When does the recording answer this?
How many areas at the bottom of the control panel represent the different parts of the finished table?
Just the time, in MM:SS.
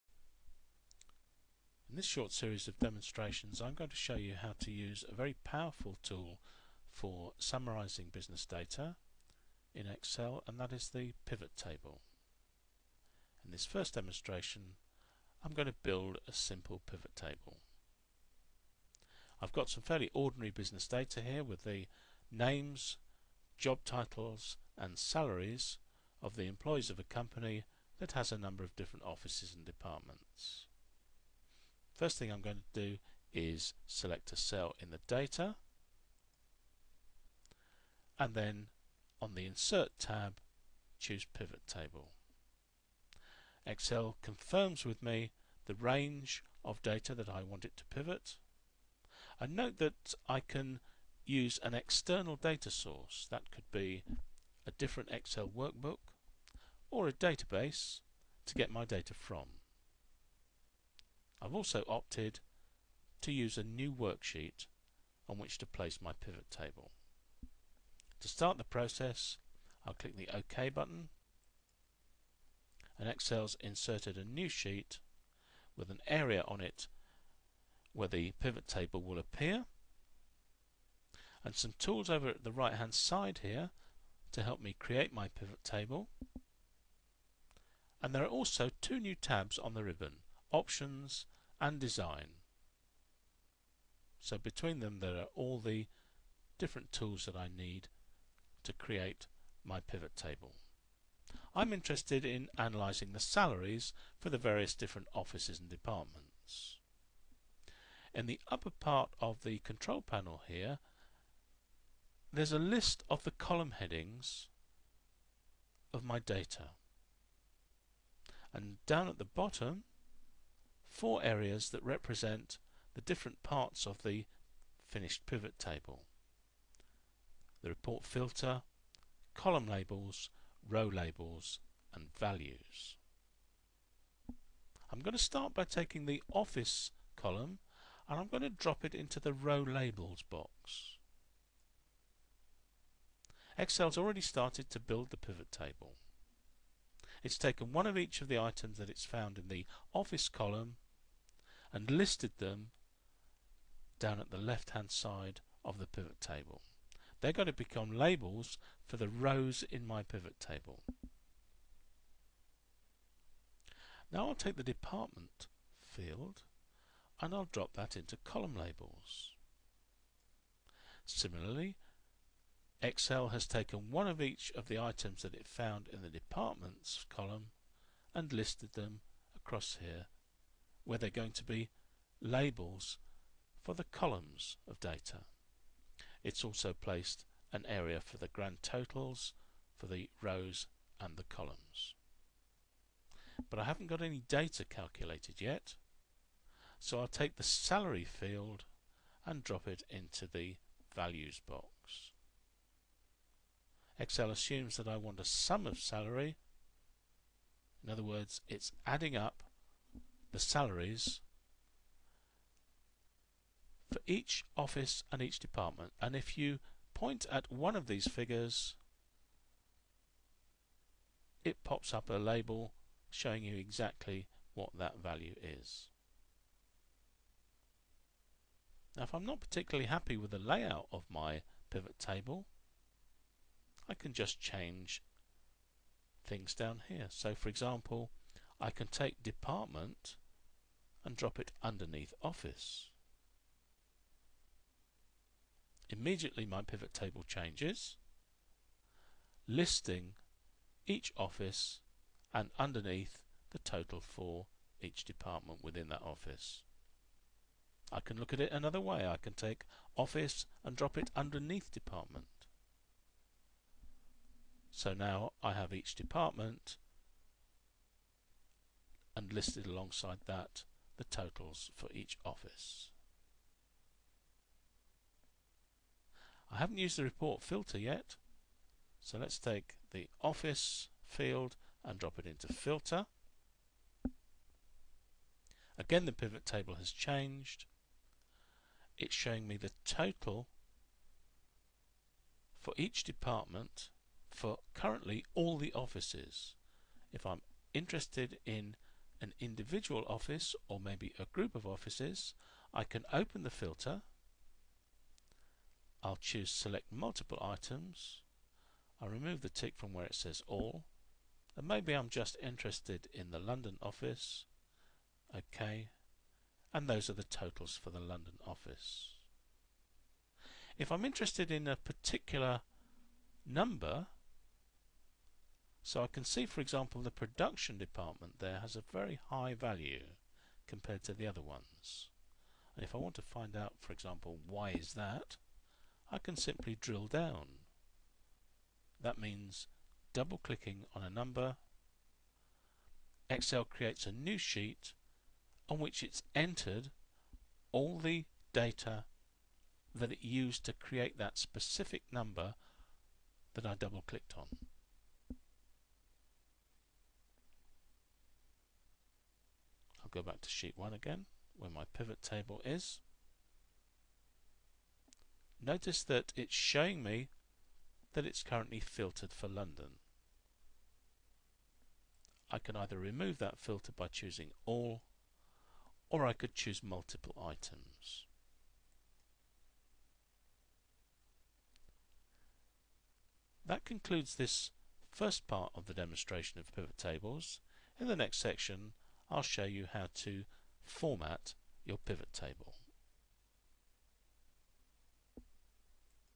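02:00.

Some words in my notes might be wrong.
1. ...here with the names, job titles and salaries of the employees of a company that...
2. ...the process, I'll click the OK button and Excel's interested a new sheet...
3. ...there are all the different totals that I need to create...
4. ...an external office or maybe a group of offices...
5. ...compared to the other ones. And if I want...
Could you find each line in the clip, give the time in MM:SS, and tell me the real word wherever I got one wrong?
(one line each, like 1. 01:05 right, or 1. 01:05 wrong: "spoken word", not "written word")
1. 00:21 right
2. 01:08 wrong: "inserted", not "interested"
3. 01:34 wrong: "tools", not "totals"
4. 04:59 wrong: "individual", not "external"
5. 05:30 right.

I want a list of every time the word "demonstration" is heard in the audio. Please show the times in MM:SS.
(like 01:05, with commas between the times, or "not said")
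00:02, 00:13, 06:25.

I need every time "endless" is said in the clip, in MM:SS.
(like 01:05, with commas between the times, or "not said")
not said.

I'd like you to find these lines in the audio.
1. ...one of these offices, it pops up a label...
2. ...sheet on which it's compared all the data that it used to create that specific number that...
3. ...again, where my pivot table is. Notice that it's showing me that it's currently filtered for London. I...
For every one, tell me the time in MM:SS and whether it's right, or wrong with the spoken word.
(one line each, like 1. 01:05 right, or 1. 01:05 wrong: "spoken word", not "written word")
1. 03:37 wrong: "figures", not "offices"
2. 05:44 wrong: "entered", not "compared"
3. 06:00 right.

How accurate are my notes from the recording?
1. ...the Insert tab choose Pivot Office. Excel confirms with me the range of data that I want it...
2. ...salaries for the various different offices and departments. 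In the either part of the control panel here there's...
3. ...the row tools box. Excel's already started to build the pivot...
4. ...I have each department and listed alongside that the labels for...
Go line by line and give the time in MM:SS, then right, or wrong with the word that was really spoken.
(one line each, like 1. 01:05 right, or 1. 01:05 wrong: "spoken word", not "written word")
1. 00:39 wrong: "Table", not "Office"
2. 01:43 wrong: "upper", not "either"
3. 02:19 wrong: "labels", not "tools"
4. 04:25 wrong: "totals", not "labels".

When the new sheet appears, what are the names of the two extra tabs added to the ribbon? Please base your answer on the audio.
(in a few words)
Options and Design.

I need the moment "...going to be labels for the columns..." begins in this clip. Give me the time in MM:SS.
03:01.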